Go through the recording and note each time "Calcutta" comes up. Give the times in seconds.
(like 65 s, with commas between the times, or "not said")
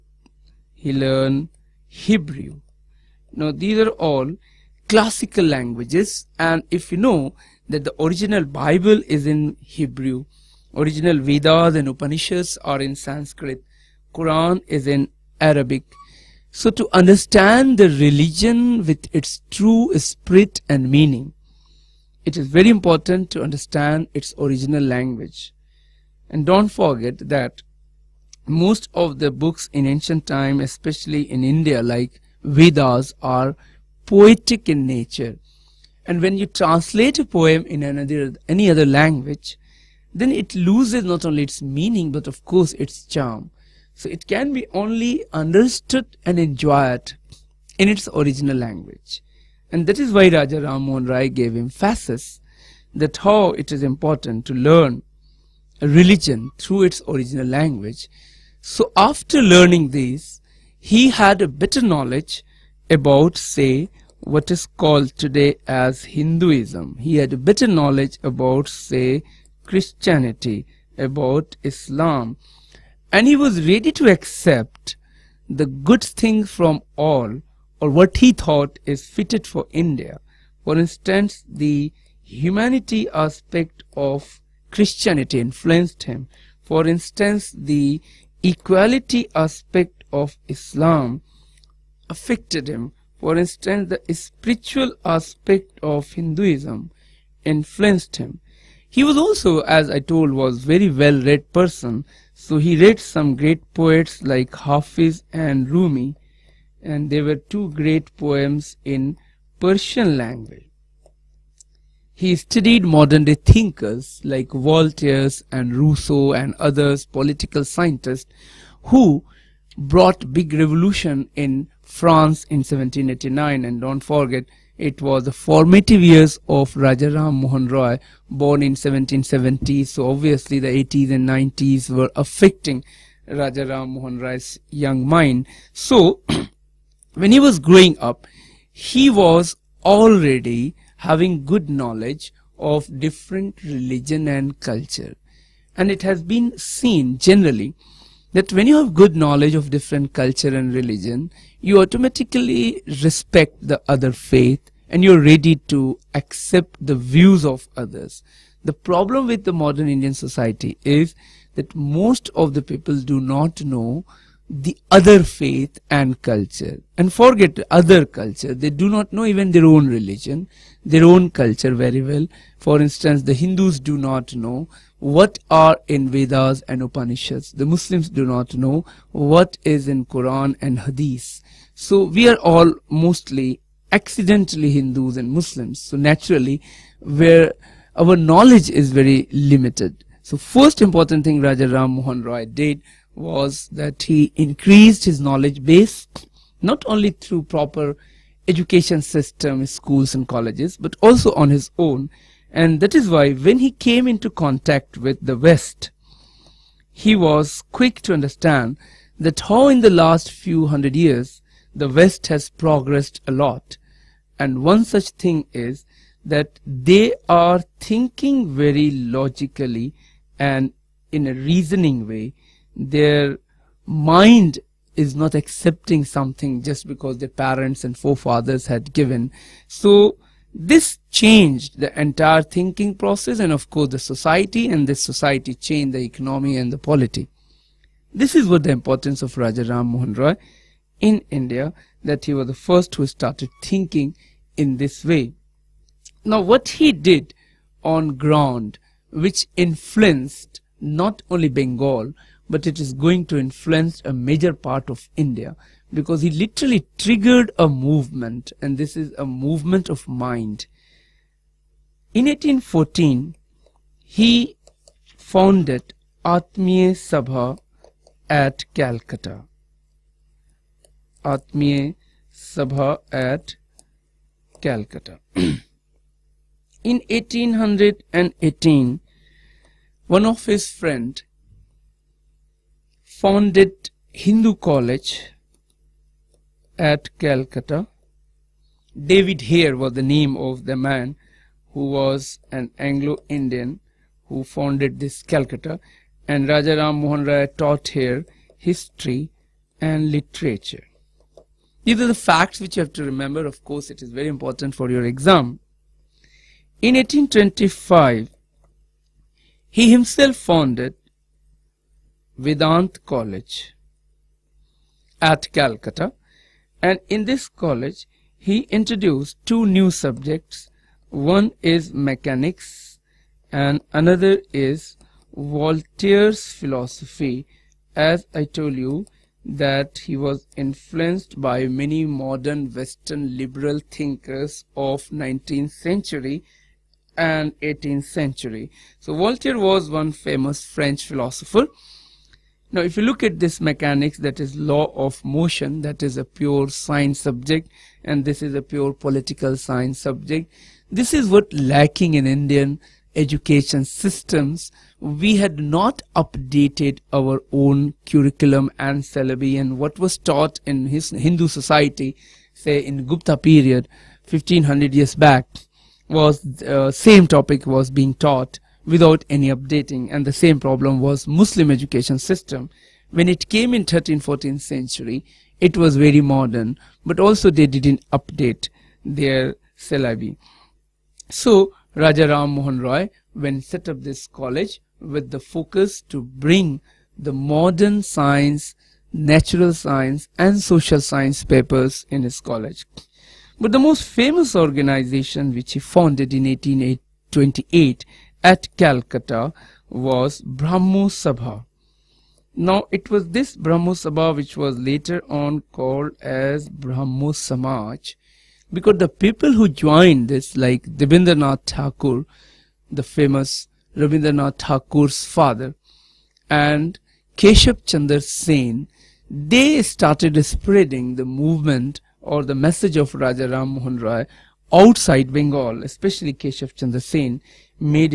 268 s, 274 s, 287 s, 295 s, 315 s, 398 s.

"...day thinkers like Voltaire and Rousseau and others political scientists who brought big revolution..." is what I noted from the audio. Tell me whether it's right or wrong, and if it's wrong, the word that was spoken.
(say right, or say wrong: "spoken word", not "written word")
right.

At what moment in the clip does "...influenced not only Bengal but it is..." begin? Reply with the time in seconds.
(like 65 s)
249 s.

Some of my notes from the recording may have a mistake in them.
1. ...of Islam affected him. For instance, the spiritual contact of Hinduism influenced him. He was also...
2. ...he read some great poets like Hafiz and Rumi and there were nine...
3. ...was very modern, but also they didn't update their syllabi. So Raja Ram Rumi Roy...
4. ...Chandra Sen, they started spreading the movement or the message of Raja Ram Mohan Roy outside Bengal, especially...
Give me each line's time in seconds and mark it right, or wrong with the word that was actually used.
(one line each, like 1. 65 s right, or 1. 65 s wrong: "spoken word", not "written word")
1. 90 s wrong: "aspect", not "contact"
2. 102 s wrong: "two", not "nine"
3. 375 s wrong: "Mohan", not "Rumi"
4. 417 s right.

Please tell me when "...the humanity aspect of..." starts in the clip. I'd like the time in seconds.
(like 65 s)
81 s.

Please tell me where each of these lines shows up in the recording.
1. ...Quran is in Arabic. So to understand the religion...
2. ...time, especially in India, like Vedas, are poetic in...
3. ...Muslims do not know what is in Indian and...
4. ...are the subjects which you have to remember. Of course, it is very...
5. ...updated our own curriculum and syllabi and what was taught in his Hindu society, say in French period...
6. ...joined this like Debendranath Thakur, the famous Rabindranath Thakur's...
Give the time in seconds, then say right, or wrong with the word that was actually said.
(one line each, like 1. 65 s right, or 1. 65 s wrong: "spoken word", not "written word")
1. 14 s right
2. 30 s right
3. 177 s wrong: "Quran", not "Indian"
4. 301 s wrong: "facts", not "subjects"
5. 356 s wrong: "Gupta", not "French"
6. 409 s right.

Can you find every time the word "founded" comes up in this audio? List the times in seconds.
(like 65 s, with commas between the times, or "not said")
265 s, 283 s, 294 s, 310 s, 395 s.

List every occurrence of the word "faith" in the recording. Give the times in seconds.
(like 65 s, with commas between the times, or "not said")
154 s, 165 s.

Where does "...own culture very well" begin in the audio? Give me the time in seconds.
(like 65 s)
171 s.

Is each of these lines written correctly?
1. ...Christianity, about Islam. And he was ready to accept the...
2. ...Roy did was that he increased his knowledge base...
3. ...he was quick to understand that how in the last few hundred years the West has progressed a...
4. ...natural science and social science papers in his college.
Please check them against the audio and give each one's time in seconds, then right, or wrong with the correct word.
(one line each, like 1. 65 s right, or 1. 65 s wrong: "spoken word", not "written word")
1. 69 s right
2. 192 s right
3. 206 s right
4. 389 s right.